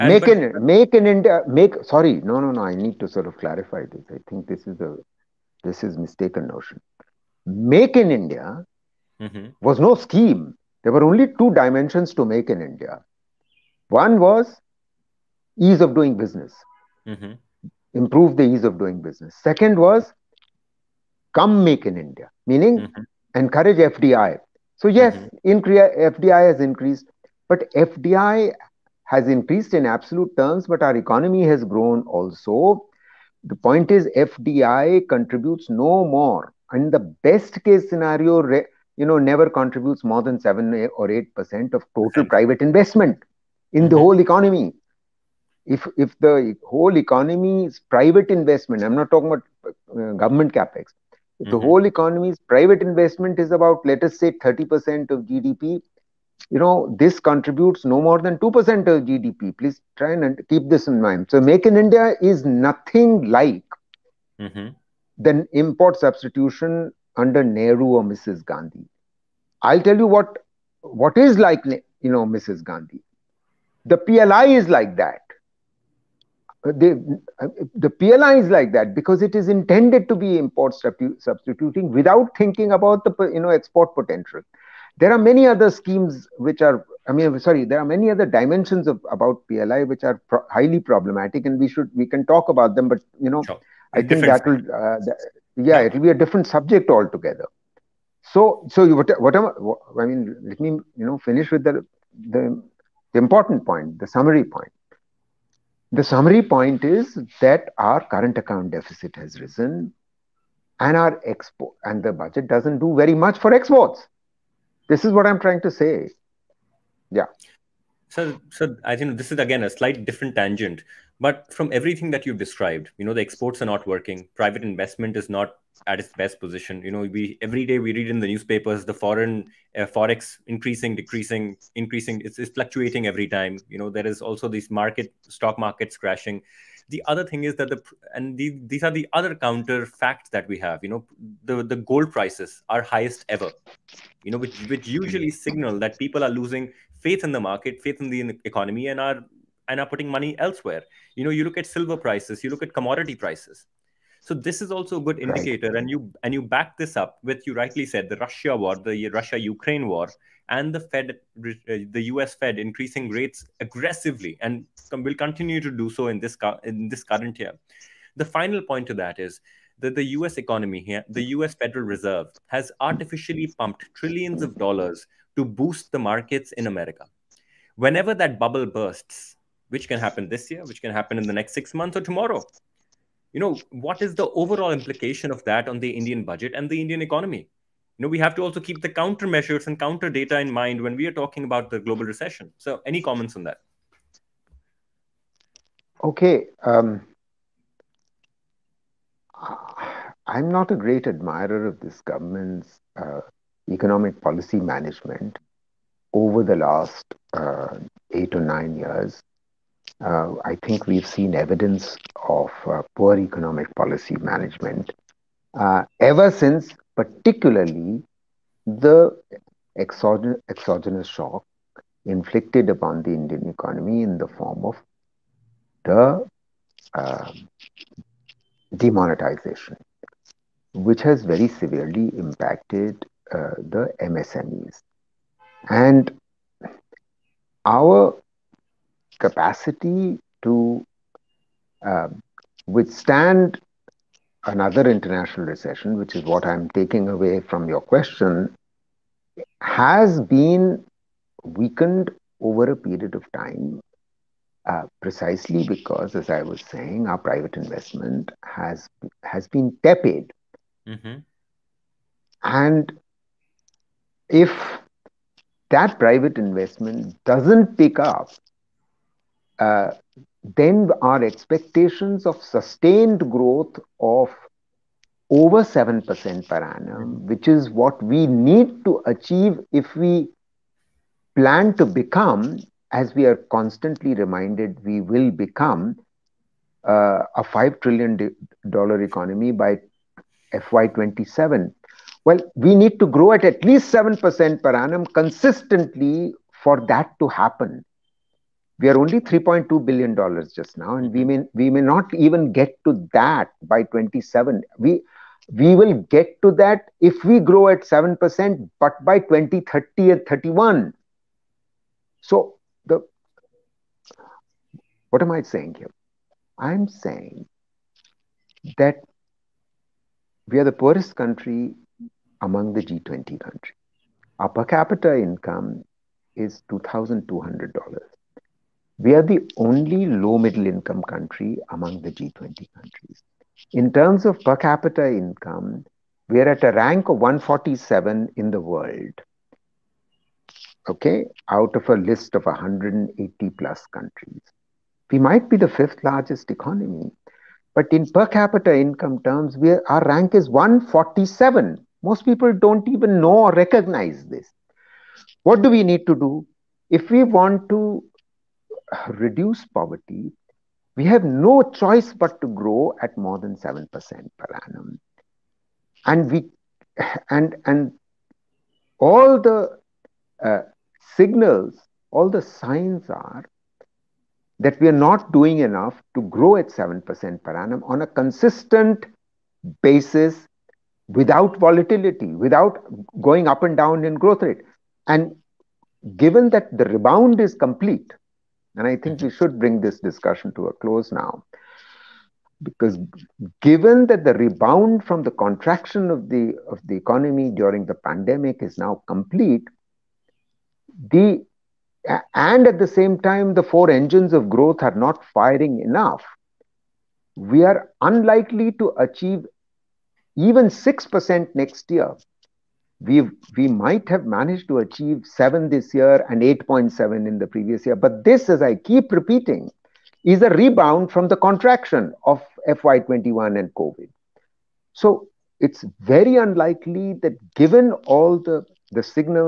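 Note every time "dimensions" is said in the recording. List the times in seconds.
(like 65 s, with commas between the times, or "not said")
11 s, 88 s.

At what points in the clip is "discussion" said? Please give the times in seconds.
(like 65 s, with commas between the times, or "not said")
389 s.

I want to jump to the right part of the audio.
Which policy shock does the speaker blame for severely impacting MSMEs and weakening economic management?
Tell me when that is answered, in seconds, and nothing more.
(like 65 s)
228 s.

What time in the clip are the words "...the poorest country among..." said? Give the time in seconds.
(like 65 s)
320 s.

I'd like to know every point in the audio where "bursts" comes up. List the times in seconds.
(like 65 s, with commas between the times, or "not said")
178 s.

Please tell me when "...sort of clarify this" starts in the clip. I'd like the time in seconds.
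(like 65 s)
3 s.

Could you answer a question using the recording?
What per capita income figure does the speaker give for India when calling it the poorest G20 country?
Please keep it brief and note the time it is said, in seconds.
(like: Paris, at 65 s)
$2200, at 326 s.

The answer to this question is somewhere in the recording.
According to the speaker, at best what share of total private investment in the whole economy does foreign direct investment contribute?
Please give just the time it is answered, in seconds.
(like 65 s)
40 s.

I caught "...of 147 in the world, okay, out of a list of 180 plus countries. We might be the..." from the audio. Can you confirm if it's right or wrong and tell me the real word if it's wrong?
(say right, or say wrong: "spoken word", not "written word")
right.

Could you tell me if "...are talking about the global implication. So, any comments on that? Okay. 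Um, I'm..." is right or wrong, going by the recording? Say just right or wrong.
wrong.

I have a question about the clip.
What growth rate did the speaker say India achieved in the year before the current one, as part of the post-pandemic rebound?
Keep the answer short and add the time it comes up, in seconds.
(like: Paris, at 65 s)
8.7, at 416 s.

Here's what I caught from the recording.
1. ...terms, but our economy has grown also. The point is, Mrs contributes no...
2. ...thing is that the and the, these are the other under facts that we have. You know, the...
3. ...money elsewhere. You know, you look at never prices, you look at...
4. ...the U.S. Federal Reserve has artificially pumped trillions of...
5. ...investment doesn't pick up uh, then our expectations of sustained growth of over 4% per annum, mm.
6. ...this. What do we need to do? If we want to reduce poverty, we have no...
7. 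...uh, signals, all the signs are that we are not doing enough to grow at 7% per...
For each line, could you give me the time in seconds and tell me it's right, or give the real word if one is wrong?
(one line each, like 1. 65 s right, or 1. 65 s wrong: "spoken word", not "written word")
1. 30 s wrong: "FDI", not "Mrs"
2. 137 s wrong: "counter", not "under"
3. 150 s wrong: "silver", not "never"
4. 171 s right
5. 266 s wrong: "7", not "4"
6. 354 s right
7. 370 s right.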